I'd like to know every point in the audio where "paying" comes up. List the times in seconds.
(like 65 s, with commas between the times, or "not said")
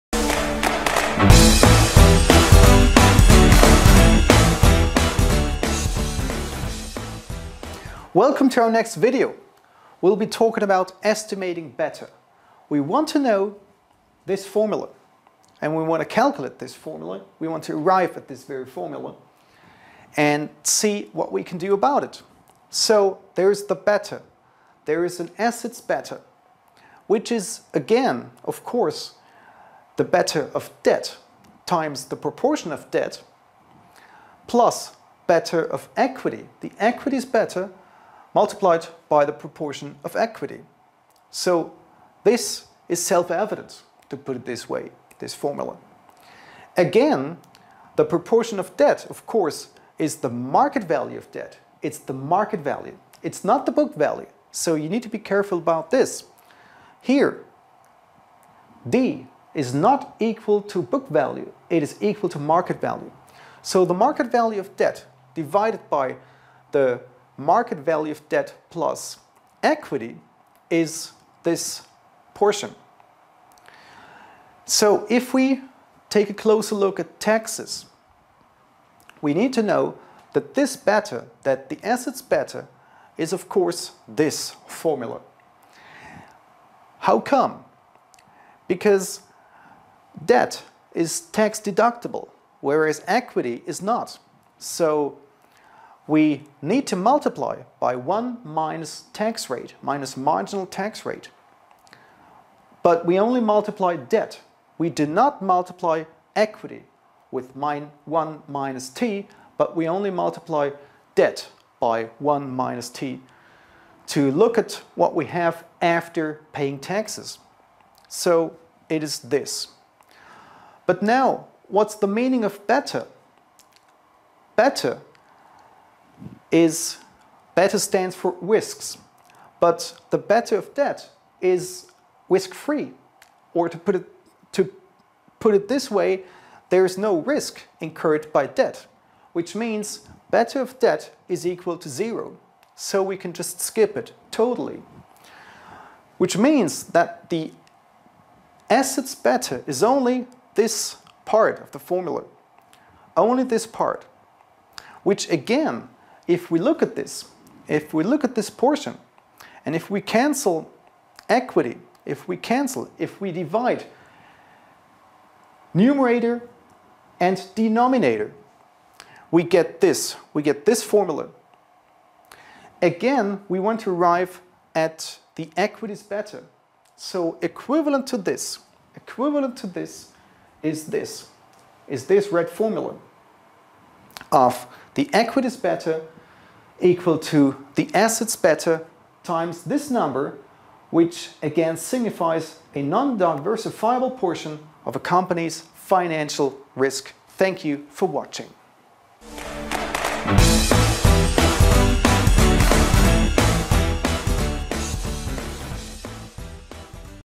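116 s.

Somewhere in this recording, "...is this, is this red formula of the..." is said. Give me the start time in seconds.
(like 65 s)
180 s.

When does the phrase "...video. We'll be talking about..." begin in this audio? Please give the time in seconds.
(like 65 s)
8 s.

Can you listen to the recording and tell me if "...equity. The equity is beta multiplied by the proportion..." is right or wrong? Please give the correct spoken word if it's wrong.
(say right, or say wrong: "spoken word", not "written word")
right.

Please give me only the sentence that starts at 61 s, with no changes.
It is equal to market value.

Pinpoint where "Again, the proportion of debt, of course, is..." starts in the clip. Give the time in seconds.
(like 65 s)
46 s.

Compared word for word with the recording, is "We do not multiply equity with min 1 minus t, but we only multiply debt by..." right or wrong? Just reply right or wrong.
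right.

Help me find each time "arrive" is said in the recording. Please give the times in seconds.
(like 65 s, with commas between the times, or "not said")
17 s, 173 s.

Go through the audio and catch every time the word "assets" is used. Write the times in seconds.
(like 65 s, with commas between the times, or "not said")
25 s, 81 s, 148 s, 187 s.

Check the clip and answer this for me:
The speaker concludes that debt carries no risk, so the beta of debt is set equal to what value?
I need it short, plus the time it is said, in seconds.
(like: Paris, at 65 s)
0, at 141 s.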